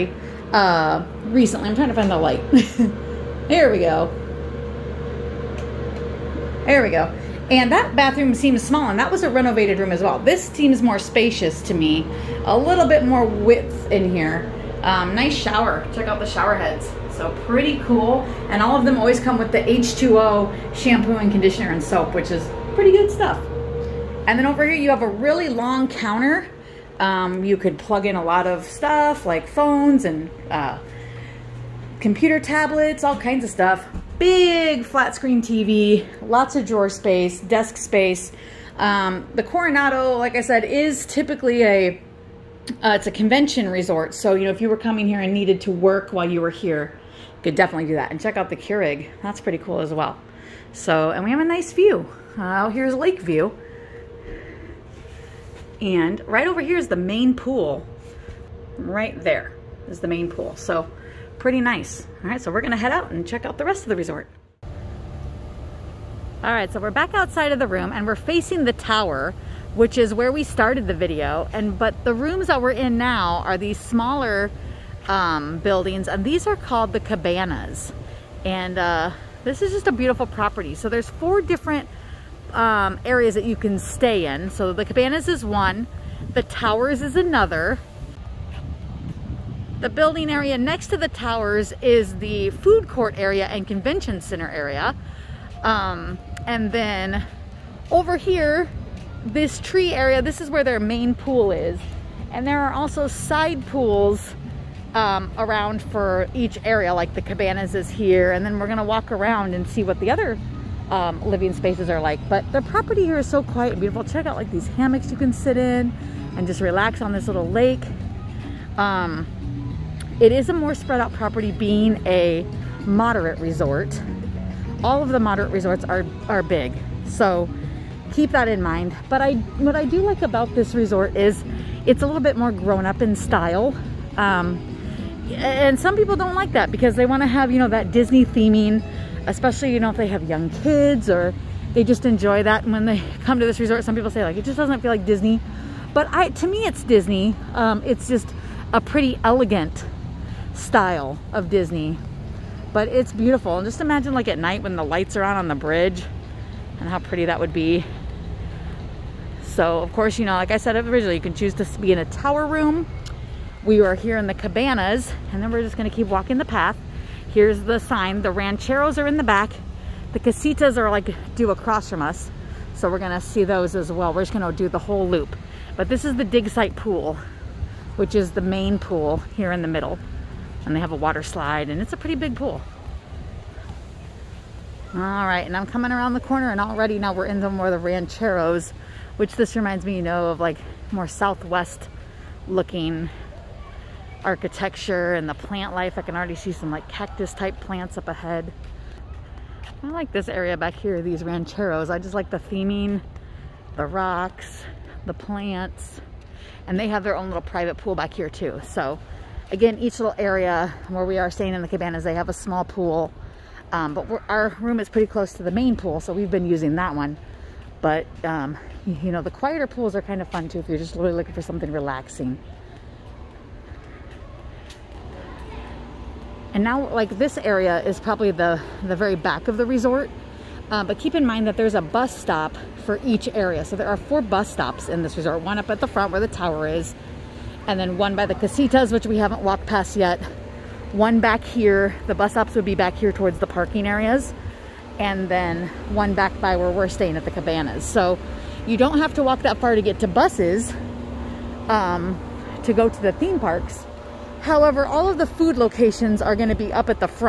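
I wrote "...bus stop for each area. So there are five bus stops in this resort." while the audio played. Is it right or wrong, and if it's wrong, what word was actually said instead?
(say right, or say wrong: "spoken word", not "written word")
wrong: "four", not "five".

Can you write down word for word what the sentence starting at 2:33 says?
And just imagine like at night when the lights are on on the bridge and how pretty that would be.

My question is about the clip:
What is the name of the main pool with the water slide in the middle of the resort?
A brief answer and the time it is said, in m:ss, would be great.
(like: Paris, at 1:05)
Dig site pool, at 2:56.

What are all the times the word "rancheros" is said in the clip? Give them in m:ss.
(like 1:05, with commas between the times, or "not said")
2:48, 3:07, 3:21.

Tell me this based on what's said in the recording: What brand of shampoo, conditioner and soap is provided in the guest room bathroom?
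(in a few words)
H2O.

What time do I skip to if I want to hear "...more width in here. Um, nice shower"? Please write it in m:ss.
0:13.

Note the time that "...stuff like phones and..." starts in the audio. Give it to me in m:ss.
0:28.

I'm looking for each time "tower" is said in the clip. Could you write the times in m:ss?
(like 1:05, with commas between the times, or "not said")
1:08, 1:26, 1:31, 2:42, 3:56.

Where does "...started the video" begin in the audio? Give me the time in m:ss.
1:10.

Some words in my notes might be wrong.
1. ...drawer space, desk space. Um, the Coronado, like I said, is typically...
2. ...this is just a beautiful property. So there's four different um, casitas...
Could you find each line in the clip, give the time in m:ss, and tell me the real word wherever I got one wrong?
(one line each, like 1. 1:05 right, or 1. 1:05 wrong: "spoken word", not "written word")
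1. 0:36 right
2. 1:19 wrong: "areas", not "casitas".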